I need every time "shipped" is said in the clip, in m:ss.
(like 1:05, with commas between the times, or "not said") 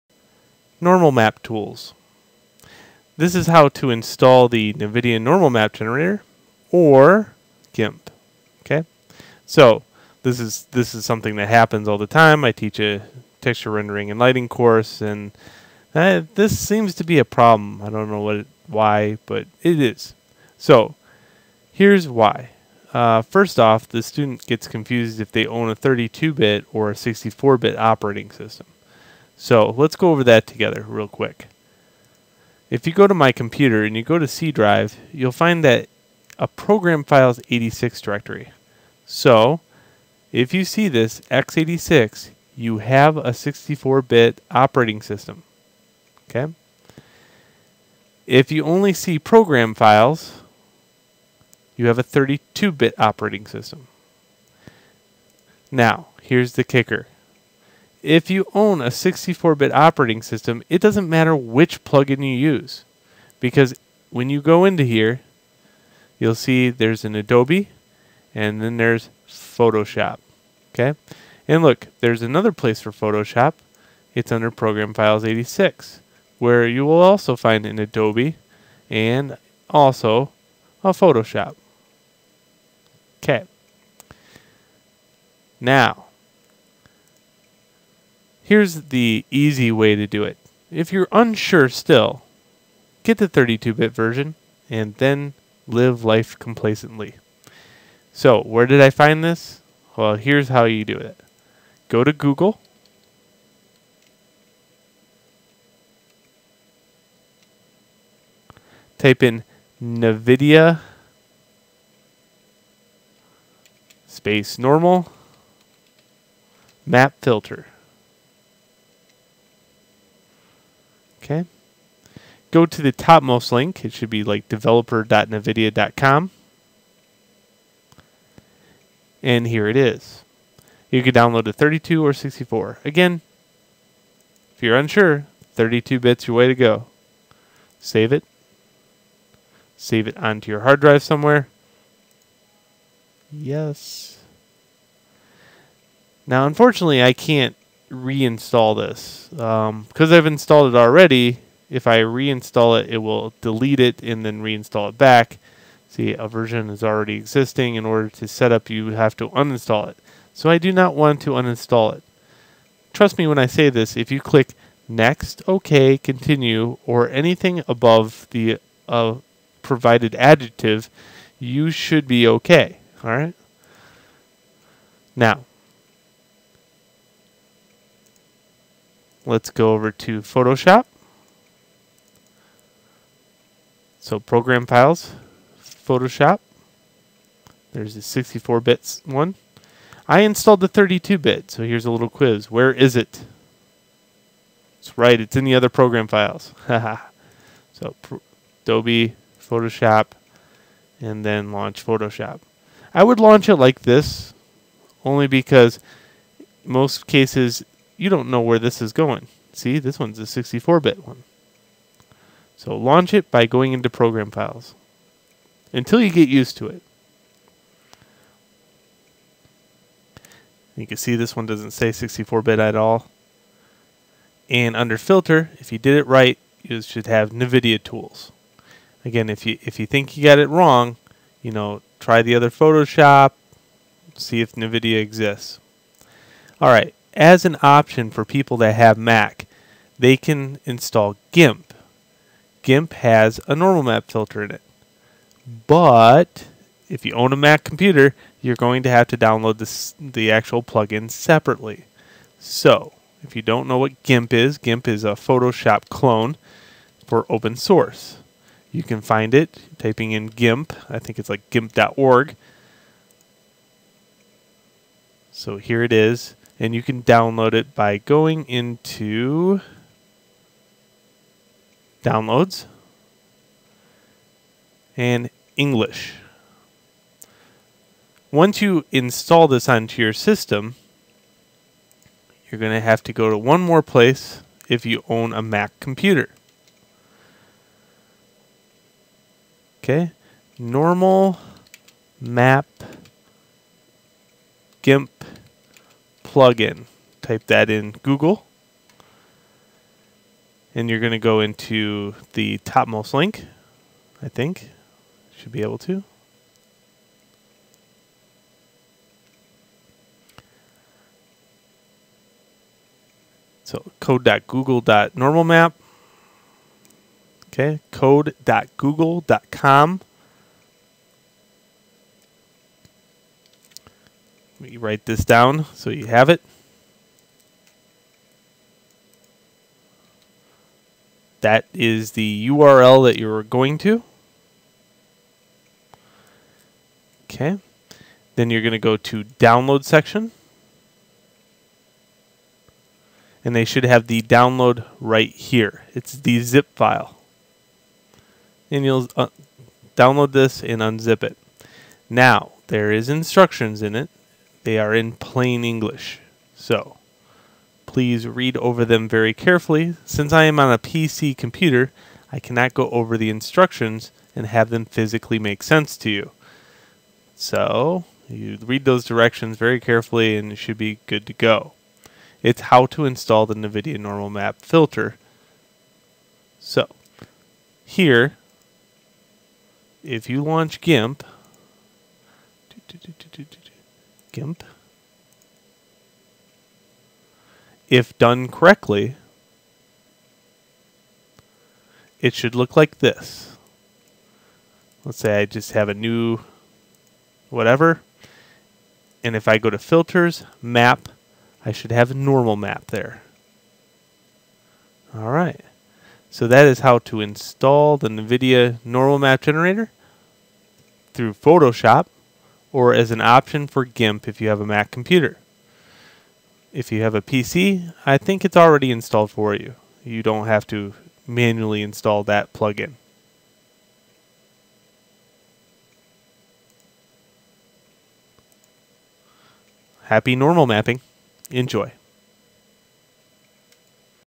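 not said.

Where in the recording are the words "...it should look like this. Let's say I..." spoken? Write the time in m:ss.
6:32.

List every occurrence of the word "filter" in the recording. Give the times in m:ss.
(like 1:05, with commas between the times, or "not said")
1:57, 3:44, 4:04, 6:14, 6:39.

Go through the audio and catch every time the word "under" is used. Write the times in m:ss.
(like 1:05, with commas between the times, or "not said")
1:14, 3:44.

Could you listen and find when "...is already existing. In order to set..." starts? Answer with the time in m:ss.
2:36.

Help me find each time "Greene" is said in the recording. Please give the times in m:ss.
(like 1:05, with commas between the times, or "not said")
not said.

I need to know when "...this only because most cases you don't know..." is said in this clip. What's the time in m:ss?
3:23.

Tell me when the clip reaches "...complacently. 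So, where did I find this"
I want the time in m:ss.
1:36.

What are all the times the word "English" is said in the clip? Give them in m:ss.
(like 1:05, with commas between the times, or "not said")
4:35, 5:55.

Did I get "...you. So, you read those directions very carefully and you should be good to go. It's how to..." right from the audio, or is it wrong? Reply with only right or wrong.
right.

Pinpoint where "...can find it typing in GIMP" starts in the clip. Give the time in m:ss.
4:18.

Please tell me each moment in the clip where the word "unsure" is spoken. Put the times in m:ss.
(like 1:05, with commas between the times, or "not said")
1:31, 2:14.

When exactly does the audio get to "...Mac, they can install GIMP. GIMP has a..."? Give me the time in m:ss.
3:58.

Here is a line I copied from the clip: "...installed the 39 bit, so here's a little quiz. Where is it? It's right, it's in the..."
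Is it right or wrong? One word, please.
wrong.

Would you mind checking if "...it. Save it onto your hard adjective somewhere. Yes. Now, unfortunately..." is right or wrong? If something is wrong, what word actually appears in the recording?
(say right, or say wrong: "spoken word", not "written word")
wrong: "drive", not "adjective".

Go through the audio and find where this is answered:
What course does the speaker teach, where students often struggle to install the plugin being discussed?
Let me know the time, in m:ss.
0:13.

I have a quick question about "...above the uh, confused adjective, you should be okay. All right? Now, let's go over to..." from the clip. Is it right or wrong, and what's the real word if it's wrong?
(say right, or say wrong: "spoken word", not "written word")
wrong: "provided", not "confused".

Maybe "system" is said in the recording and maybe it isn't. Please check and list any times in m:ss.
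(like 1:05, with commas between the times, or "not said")
0:28, 0:45, 0:53, 1:00, 4:40.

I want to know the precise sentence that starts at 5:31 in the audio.
That is the URL that you're going to.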